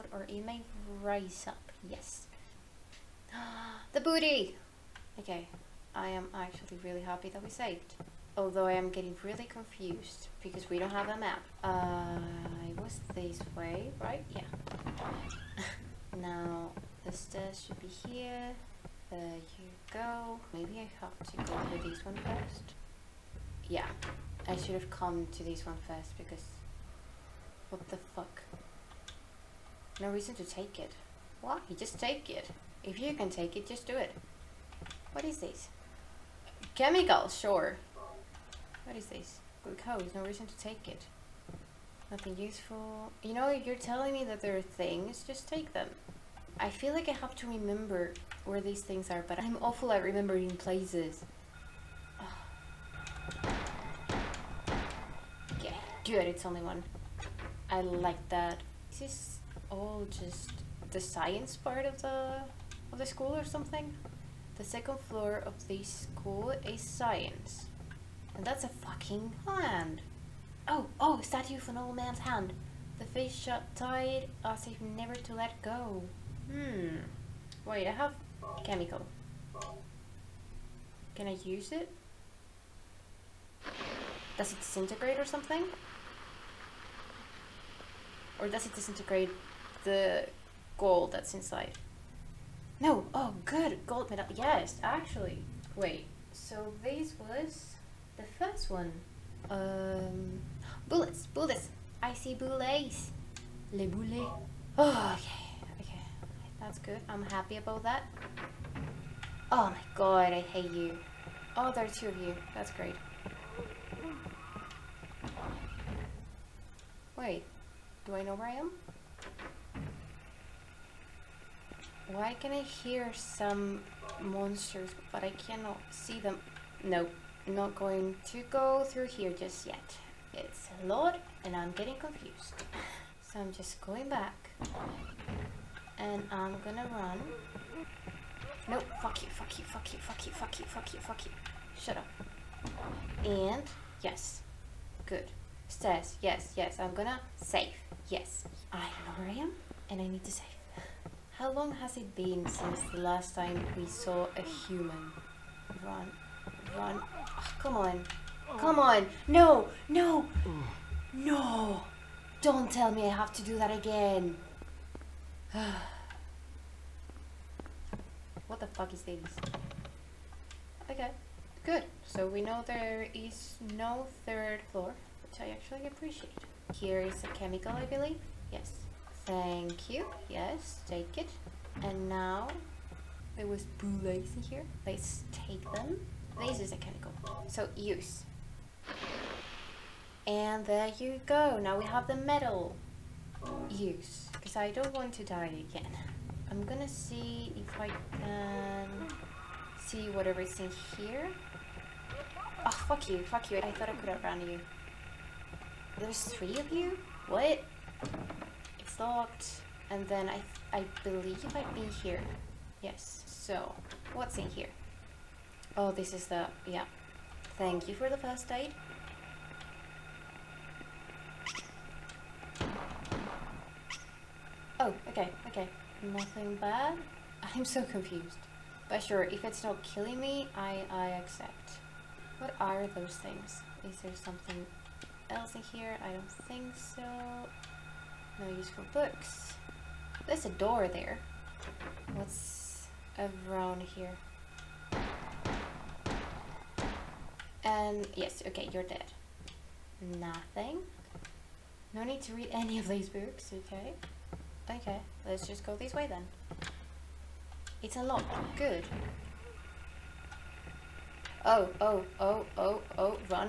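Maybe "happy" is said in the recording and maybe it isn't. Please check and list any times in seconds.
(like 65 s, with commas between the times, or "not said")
7 s, 107 s.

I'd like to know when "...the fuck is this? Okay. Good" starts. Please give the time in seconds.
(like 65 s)
168 s.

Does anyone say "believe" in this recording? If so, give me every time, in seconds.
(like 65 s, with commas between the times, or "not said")
177 s, 211 s.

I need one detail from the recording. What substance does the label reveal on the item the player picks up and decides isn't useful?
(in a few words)
Glucose.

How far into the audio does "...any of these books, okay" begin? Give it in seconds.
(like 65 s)
252 s.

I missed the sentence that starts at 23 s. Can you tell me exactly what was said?
Yeah, I should have come to this one first because what the fuck?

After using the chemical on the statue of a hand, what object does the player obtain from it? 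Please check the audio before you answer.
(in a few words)
Gold medal.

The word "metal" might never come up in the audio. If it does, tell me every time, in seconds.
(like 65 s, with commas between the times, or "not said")
192 s.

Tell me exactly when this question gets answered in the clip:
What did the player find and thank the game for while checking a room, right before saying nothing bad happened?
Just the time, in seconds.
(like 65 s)
218 s.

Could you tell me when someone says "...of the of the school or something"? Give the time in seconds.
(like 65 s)
61 s.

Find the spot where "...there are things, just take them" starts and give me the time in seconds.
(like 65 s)
44 s.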